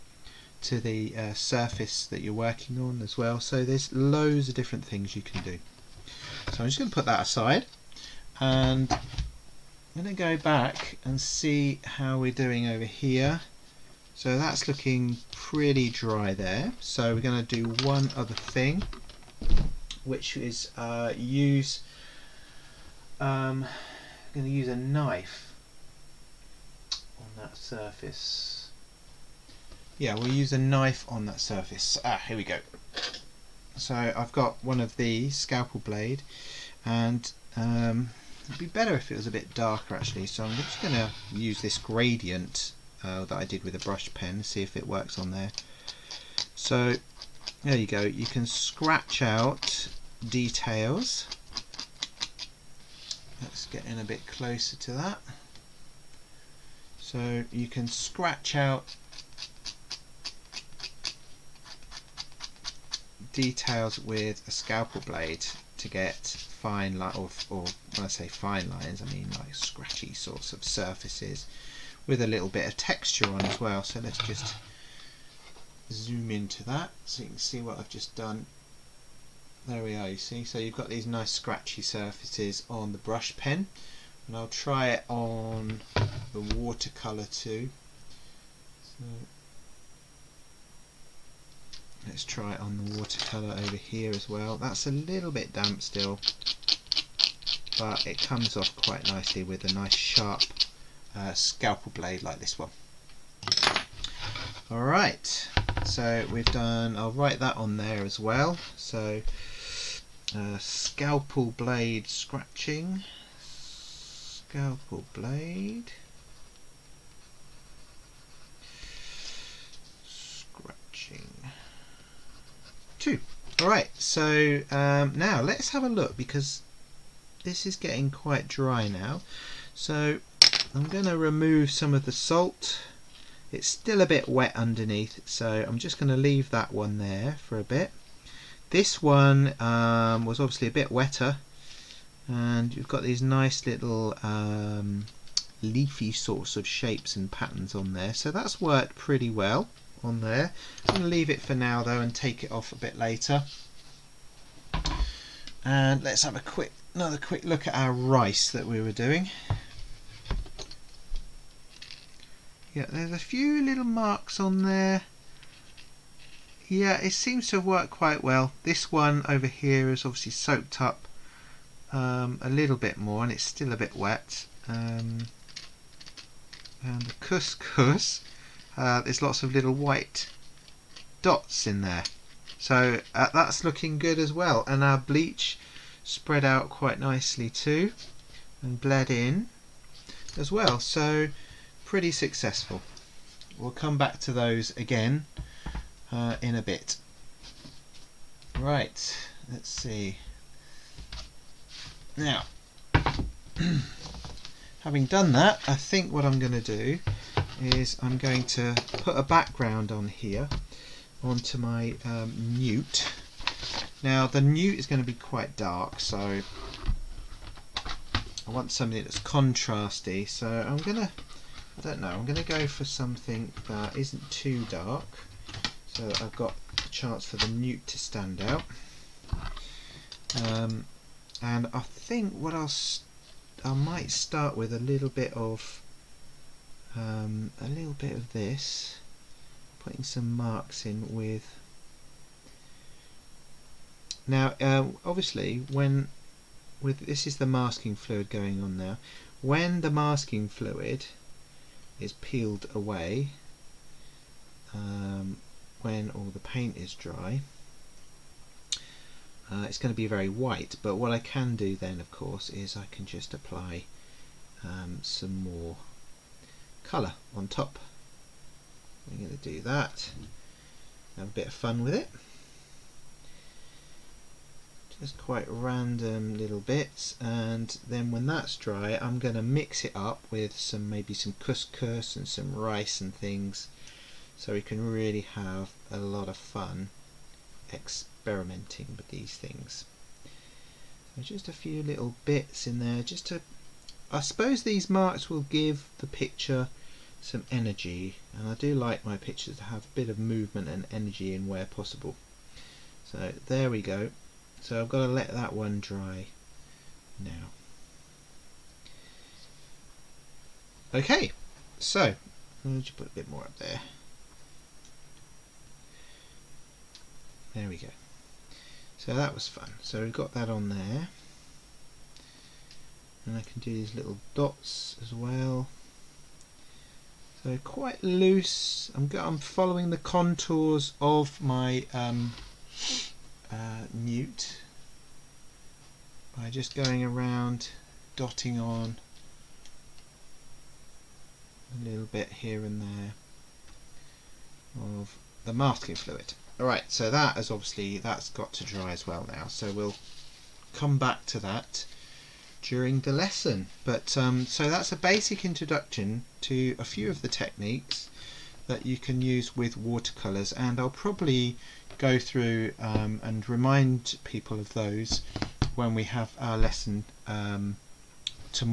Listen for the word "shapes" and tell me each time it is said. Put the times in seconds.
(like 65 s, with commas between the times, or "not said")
146 s.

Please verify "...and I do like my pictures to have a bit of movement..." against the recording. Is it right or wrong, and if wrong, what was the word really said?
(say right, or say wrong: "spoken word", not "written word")
right.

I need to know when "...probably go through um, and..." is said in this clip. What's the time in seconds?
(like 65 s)
360 s.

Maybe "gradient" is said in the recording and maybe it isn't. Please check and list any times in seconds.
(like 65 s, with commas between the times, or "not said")
41 s.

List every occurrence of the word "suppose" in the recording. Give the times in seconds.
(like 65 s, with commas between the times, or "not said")
294 s.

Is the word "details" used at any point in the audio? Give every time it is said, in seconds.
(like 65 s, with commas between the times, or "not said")
50 s, 63 s.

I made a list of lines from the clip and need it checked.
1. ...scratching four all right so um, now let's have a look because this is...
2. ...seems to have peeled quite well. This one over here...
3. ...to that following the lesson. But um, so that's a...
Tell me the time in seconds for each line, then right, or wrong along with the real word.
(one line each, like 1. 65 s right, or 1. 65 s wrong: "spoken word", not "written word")
1. 120 s wrong: "two", not "four"
2. 167 s wrong: "worked", not "peeled"
3. 351 s wrong: "during", not "following".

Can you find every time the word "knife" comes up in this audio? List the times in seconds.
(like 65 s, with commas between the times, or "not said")
24 s, 30 s.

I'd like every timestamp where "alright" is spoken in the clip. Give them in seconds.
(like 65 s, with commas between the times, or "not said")
104 s, 346 s.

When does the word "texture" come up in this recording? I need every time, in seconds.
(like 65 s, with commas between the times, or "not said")
72 s.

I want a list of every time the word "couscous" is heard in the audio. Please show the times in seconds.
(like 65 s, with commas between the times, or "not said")
177 s, 281 s.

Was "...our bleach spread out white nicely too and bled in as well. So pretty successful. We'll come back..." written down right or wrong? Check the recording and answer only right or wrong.
wrong.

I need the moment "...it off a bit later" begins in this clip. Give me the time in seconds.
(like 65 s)
152 s.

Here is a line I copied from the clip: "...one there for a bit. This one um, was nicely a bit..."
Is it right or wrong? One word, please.
wrong.